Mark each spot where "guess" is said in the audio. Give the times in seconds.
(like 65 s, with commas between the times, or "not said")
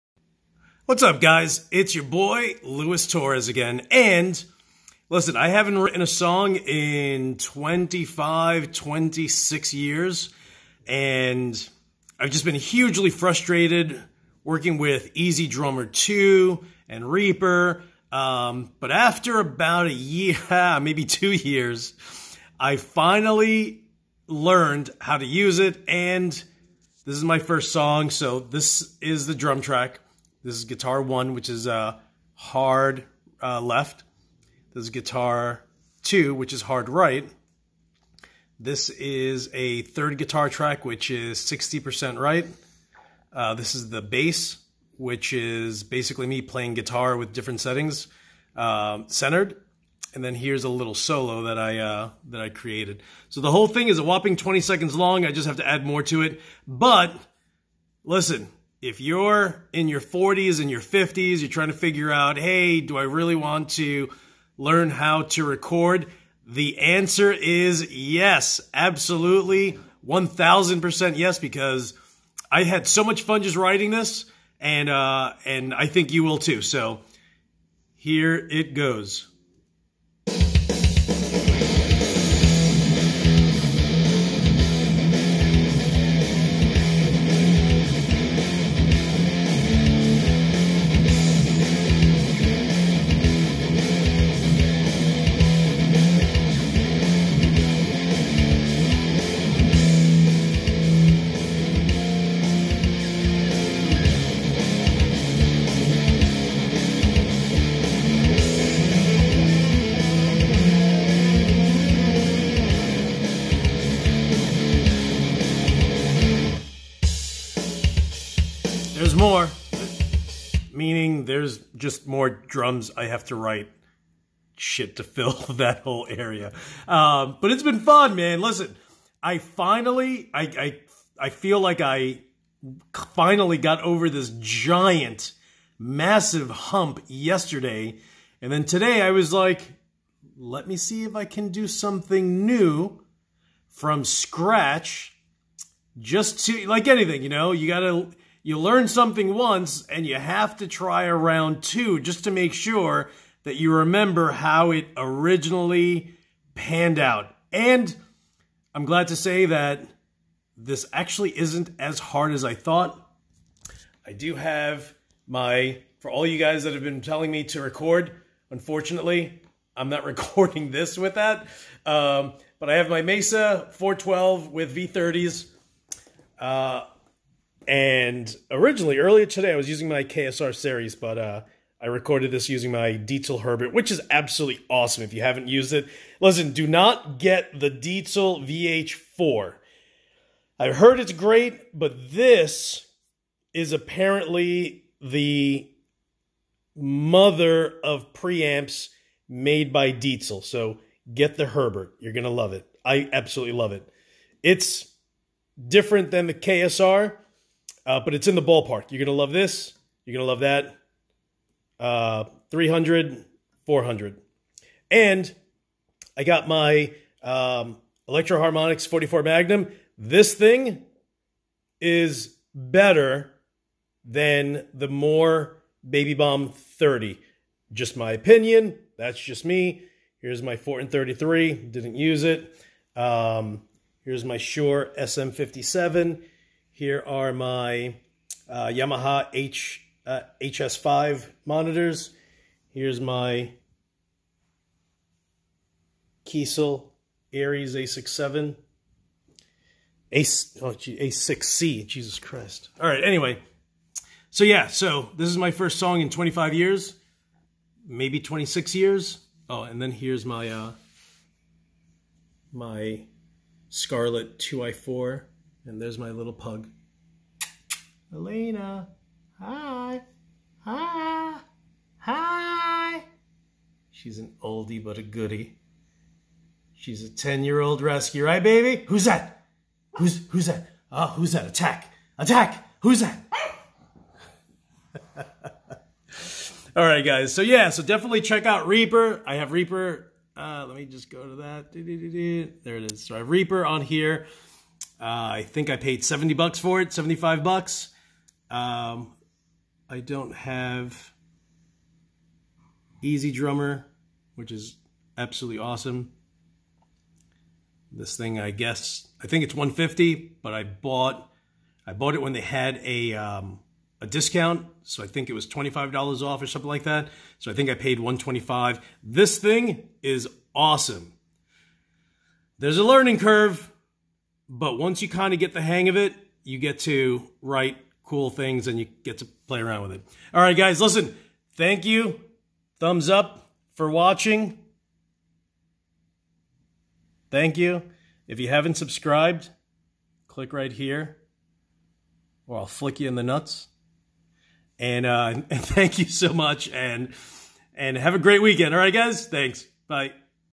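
308 s.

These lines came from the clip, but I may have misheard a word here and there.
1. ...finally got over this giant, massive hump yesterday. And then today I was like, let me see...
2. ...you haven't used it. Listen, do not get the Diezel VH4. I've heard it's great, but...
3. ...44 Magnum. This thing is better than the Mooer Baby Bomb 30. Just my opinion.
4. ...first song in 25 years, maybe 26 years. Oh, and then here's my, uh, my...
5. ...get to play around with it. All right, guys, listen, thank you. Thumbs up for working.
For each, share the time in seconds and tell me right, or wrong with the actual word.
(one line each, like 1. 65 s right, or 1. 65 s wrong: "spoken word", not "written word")
1. 133 s right
2. 185 s right
3. 218 s right
4. 255 s right
5. 329 s wrong: "watching", not "working".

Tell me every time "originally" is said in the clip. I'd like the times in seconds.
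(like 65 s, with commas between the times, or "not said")
154 s, 178 s.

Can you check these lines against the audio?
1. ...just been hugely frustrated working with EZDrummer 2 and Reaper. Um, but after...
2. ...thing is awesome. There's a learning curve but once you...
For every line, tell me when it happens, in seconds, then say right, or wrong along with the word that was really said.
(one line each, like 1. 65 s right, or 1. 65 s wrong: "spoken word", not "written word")
1. 12 s right
2. 319 s right.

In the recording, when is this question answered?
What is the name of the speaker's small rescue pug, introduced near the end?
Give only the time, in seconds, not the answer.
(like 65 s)
268 s.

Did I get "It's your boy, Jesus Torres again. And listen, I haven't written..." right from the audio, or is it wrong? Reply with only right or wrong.
wrong.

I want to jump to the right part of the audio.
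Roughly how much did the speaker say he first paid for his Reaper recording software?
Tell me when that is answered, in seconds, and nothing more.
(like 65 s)
296 s.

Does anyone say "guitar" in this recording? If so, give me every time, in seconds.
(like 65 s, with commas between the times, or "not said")
30 s, 34 s, 40 s, 46 s.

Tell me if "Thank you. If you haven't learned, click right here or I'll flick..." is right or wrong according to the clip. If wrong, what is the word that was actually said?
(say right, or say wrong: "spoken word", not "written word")
wrong: "subscribed", not "learned".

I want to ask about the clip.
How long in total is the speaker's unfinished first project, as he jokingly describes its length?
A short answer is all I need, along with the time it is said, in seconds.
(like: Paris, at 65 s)
20 seconds, at 54 s.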